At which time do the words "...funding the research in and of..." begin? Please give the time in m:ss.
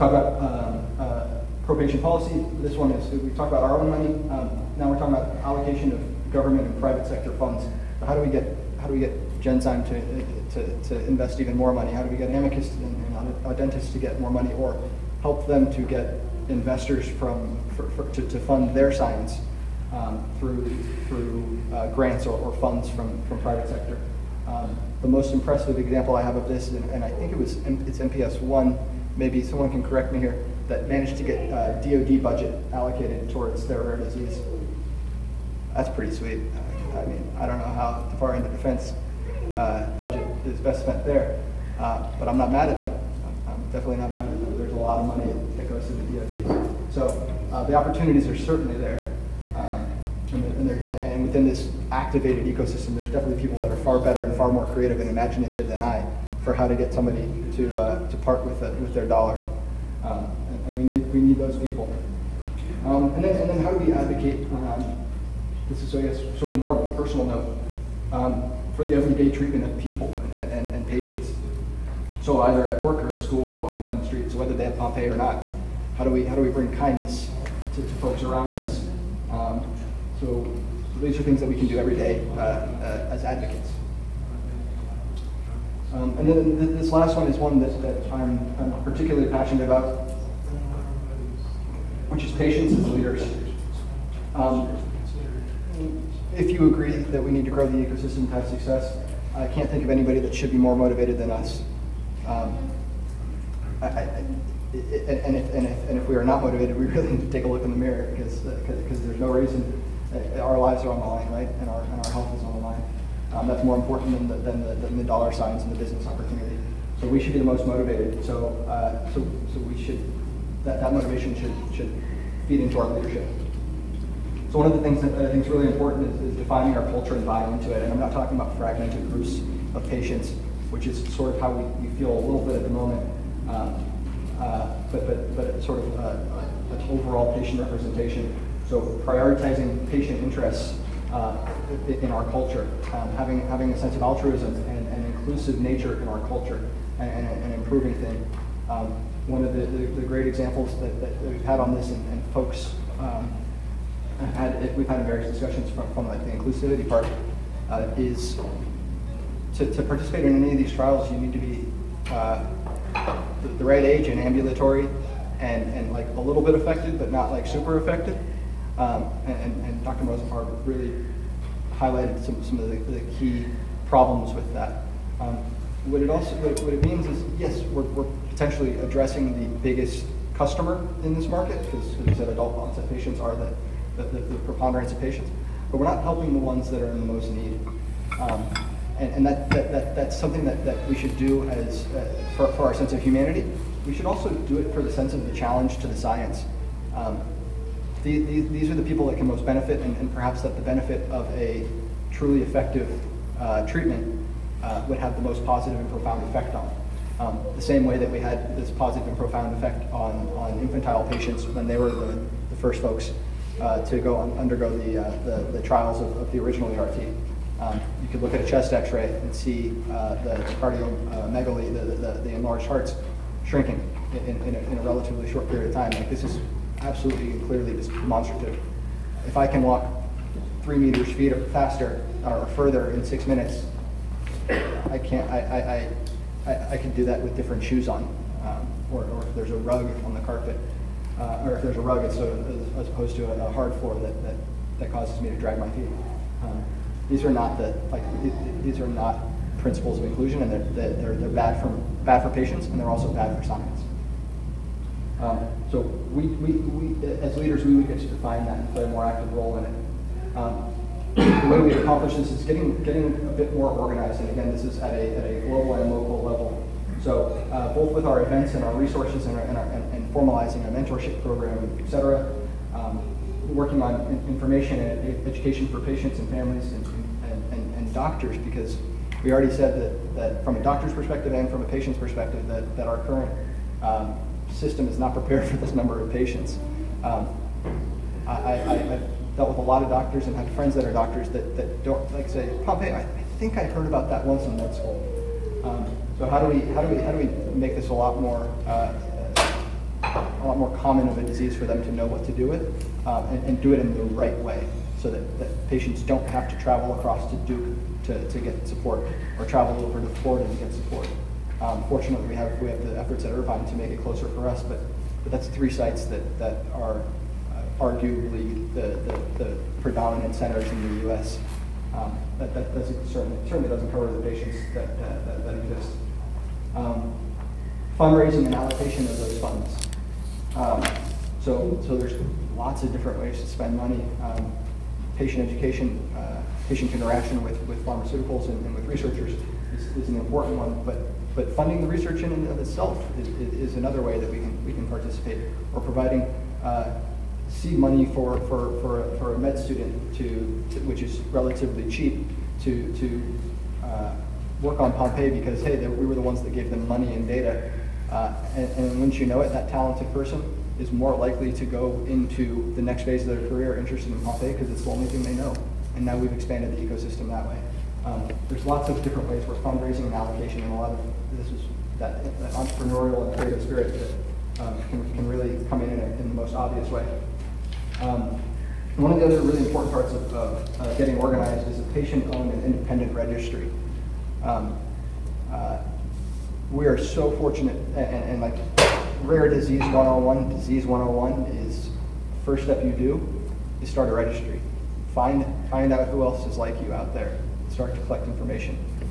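5:41.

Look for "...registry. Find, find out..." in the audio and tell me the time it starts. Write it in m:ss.
6:34.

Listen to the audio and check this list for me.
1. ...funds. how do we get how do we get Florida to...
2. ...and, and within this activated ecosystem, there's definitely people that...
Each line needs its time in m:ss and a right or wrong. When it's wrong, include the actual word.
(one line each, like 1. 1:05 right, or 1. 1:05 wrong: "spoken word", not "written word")
1. 0:07 wrong: "Genzyme", not "Florida"
2. 0:50 right.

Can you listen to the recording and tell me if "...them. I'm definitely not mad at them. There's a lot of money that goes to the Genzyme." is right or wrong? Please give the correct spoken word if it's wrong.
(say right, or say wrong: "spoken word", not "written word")
wrong: "DOD", not "Genzyme".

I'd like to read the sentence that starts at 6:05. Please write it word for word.
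And now we've expanded the ecosystem that way.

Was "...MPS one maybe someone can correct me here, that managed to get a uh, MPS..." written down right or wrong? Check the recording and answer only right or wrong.
wrong.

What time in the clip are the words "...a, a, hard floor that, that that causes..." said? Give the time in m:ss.
4:03.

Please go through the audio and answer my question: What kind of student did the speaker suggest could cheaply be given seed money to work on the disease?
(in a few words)
med student.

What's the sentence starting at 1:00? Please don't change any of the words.
Um, and we need, we need those people.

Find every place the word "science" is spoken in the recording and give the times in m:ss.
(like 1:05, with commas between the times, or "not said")
0:18, 3:15, 4:13.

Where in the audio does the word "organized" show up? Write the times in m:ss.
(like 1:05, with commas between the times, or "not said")
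4:23, 6:21.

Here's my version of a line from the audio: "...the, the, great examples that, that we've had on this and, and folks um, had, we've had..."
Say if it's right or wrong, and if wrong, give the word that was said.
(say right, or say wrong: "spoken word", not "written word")
right.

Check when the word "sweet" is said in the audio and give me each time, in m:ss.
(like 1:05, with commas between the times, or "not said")
0:36.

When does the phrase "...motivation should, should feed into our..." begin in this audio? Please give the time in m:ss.
2:00.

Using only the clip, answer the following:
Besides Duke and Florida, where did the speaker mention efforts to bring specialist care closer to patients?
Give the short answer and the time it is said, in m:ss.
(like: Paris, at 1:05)
Irvine, at 5:13.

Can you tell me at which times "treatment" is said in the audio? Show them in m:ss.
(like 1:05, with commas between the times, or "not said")
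1:09, 3:23.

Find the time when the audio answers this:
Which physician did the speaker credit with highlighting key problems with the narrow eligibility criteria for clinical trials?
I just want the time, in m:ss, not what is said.
2:49.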